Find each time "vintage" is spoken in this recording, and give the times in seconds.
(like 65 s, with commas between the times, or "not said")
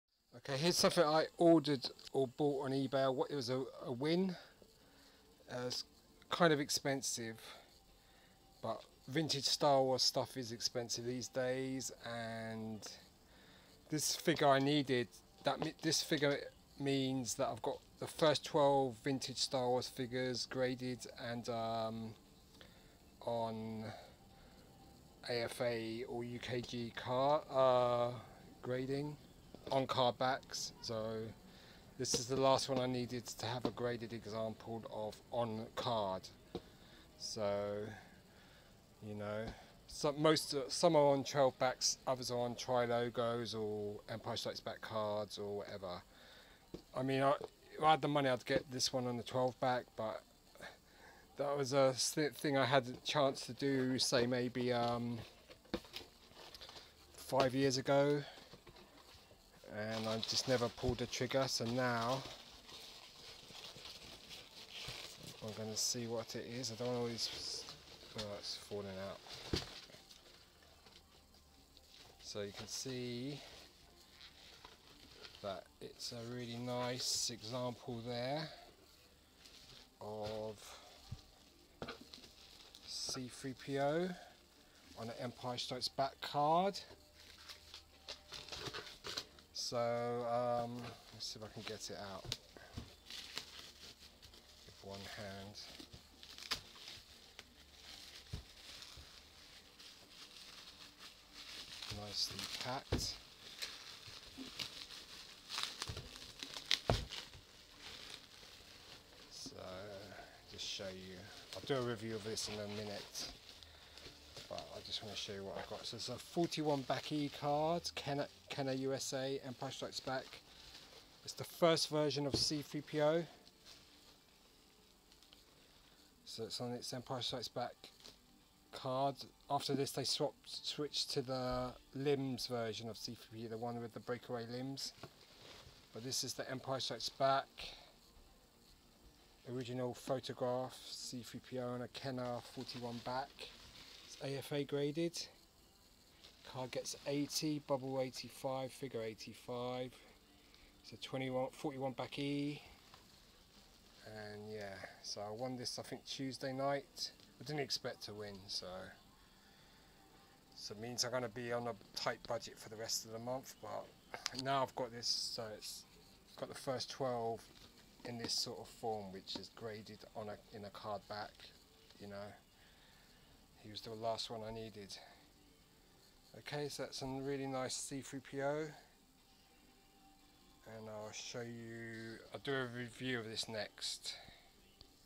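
9 s, 19 s.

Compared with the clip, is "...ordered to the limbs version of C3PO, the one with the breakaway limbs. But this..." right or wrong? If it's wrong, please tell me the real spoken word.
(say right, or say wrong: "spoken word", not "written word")
wrong: "switched", not "ordered".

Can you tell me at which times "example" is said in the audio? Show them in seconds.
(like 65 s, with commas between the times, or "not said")
34 s, 77 s.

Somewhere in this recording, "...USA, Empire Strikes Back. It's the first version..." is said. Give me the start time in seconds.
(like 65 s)
118 s.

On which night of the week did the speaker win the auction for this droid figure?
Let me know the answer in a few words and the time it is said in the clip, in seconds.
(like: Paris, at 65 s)
Tuesday, at 156 s.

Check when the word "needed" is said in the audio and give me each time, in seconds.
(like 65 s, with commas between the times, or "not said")
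14 s, 32 s, 174 s.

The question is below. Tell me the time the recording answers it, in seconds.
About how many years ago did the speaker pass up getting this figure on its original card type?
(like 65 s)
57 s.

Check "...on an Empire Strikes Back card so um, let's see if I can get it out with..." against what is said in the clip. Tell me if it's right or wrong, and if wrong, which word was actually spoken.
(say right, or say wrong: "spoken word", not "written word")
right.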